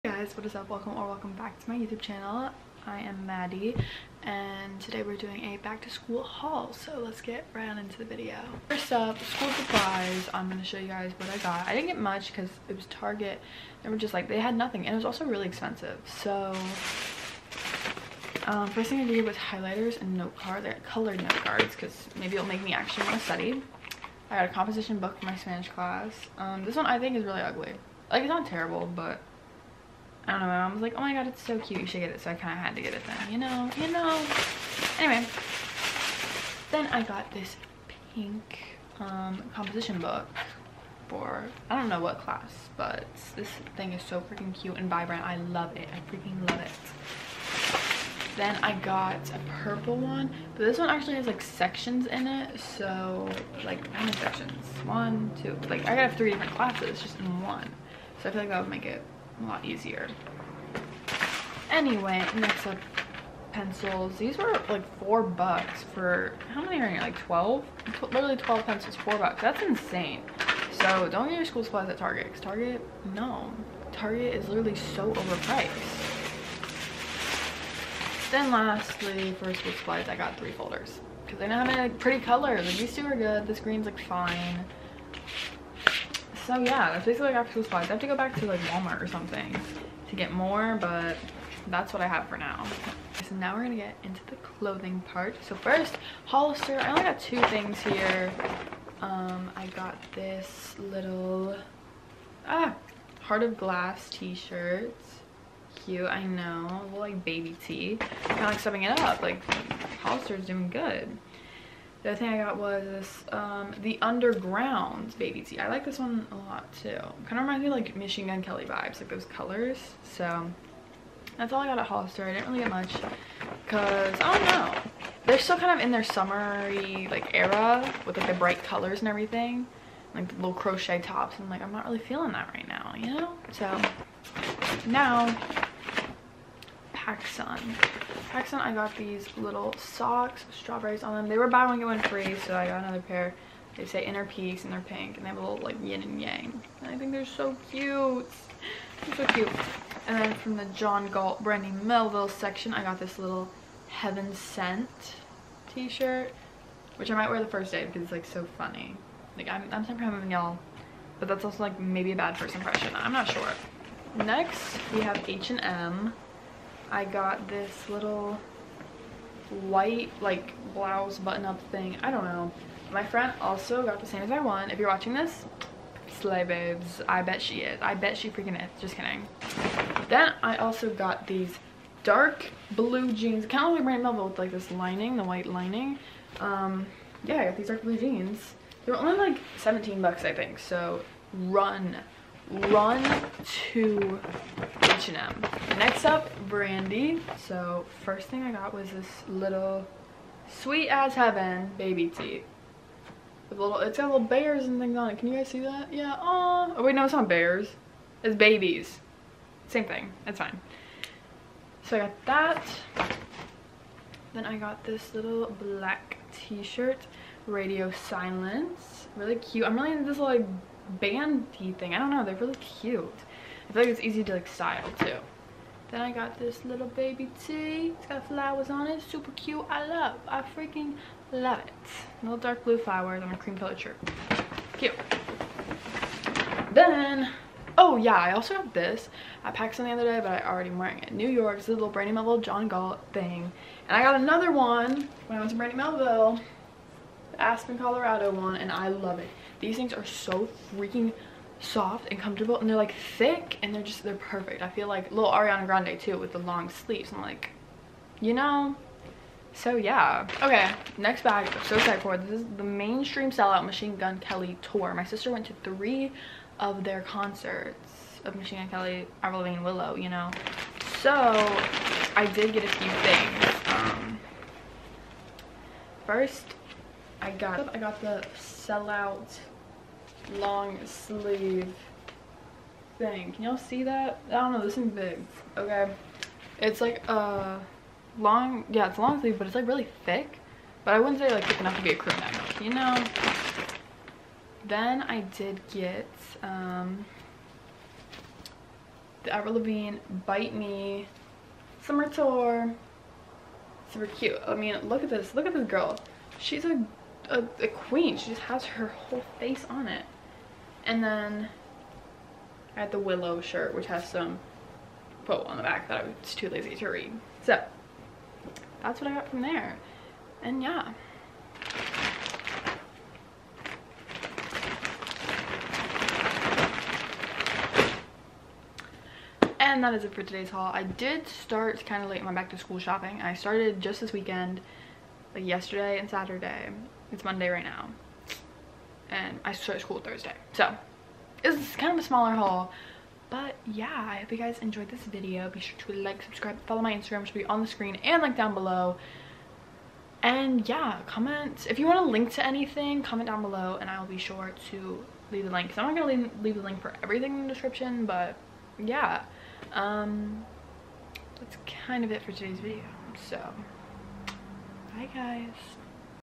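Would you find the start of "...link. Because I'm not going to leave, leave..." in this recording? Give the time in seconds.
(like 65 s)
355 s.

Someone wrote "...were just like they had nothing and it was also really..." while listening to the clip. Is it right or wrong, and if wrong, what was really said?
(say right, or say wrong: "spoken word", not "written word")
right.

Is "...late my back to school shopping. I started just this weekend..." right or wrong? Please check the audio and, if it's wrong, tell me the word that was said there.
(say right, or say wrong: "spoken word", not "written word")
right.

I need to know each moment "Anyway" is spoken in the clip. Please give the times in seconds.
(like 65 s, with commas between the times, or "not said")
34 s, 61 s.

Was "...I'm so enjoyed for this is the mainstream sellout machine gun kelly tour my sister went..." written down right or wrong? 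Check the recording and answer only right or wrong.
wrong.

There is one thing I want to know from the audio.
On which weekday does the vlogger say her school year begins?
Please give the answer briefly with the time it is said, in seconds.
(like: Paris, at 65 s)
Thursday, at 339 s.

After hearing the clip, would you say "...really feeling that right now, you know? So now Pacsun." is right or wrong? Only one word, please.
right.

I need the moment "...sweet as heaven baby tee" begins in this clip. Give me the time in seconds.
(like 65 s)
200 s.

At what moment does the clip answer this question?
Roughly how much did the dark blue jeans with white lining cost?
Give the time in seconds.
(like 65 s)
189 s.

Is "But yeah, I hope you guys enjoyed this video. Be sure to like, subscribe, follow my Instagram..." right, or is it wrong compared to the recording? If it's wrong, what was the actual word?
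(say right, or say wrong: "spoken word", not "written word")
right.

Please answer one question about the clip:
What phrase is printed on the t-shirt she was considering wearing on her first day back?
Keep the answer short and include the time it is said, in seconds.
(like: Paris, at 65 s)
Heaven Sent, at 153 s.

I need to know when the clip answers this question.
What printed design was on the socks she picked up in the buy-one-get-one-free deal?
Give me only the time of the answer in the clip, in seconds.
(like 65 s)
140 s.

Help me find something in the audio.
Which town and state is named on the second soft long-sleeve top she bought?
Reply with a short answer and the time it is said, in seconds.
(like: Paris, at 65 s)
Aspen, Colorado, at 247 s.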